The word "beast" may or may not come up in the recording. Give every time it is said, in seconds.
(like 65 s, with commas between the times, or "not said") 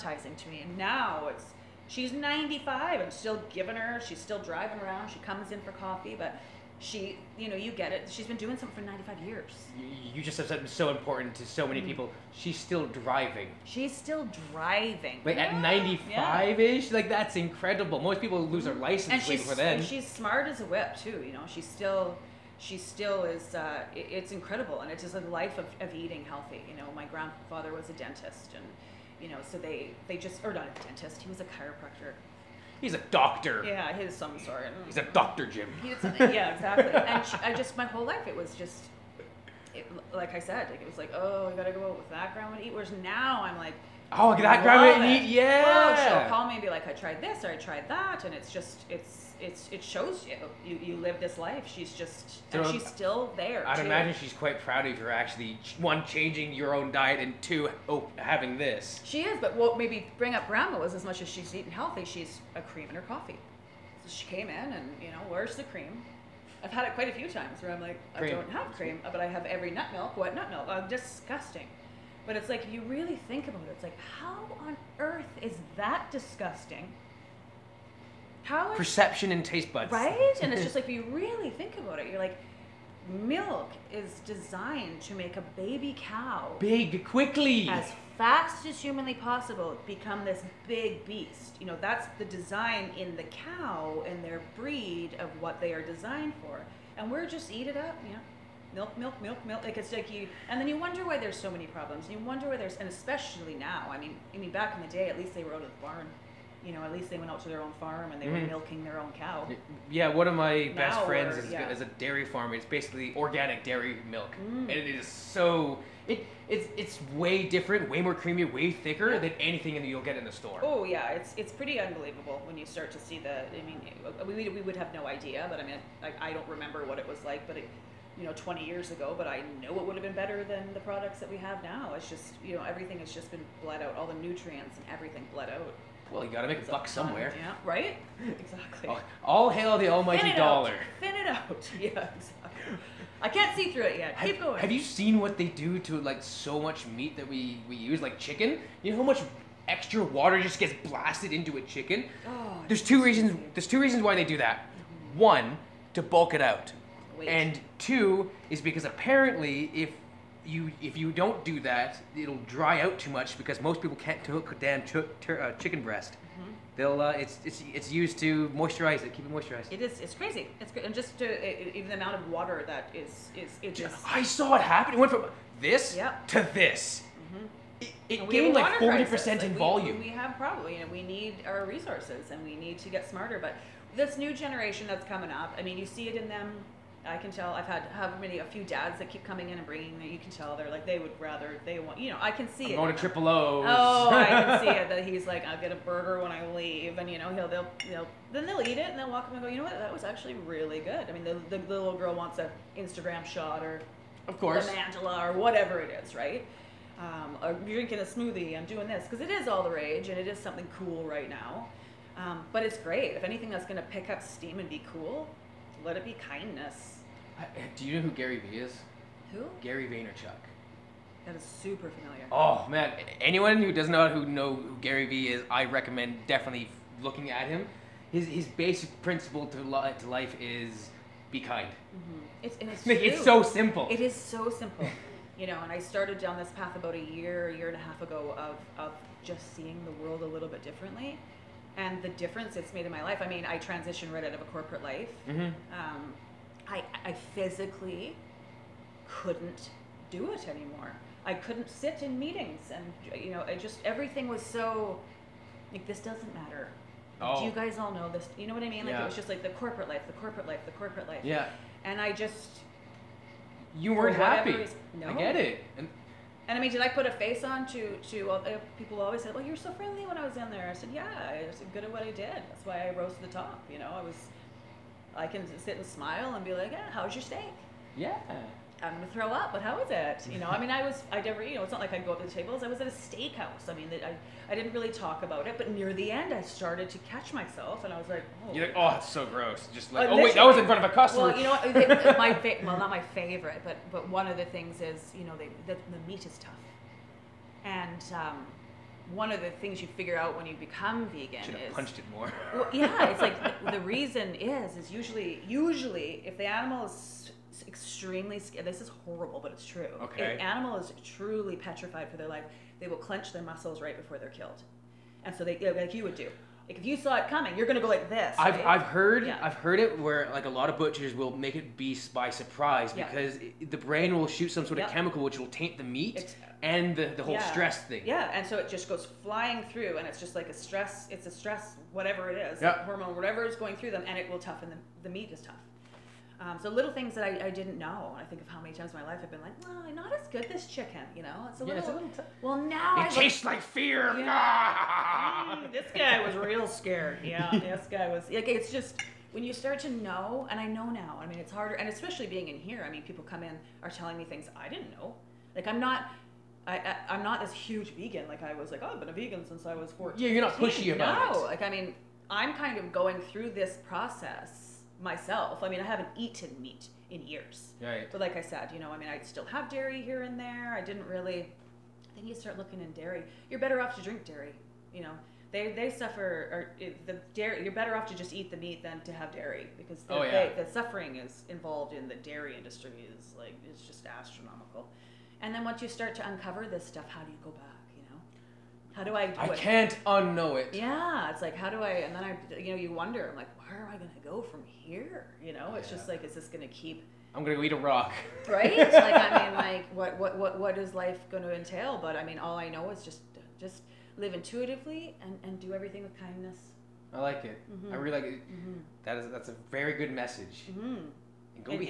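91 s, 321 s.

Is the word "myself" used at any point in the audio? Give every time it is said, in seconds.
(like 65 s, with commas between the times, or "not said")
287 s, 365 s.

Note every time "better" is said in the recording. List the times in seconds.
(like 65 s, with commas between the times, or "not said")
130 s, 373 s, 377 s.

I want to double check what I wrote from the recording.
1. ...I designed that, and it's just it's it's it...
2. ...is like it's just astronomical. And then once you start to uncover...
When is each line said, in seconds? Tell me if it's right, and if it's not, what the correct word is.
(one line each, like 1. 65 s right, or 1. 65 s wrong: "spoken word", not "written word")
1. 47 s wrong: "tried", not "designed"
2. 383 s right.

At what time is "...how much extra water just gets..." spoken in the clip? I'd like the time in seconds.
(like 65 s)
148 s.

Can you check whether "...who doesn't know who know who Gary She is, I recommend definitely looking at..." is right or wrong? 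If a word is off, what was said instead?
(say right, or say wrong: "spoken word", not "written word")
wrong: "Vee", not "She".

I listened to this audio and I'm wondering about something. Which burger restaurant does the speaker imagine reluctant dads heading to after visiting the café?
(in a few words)
Triple O's.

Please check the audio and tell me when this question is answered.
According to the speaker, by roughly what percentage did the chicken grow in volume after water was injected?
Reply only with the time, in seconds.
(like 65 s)
178 s.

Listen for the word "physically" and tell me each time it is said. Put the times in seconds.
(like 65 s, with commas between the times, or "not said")
247 s.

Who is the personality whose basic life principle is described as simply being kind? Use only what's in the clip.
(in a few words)
Gary Vaynerchuk.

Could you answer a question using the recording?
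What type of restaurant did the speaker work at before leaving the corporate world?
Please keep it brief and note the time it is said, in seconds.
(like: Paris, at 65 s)
Steakhouse, at 282 s.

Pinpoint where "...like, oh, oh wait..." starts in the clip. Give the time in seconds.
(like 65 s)
289 s.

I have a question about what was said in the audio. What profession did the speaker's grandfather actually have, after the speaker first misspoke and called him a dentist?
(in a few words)
Chiropractor.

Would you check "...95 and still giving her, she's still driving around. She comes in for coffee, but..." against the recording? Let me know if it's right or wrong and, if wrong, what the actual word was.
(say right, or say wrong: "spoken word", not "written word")
right.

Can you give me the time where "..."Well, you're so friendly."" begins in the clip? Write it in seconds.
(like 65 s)
269 s.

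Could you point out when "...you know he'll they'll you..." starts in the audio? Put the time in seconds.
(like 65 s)
197 s.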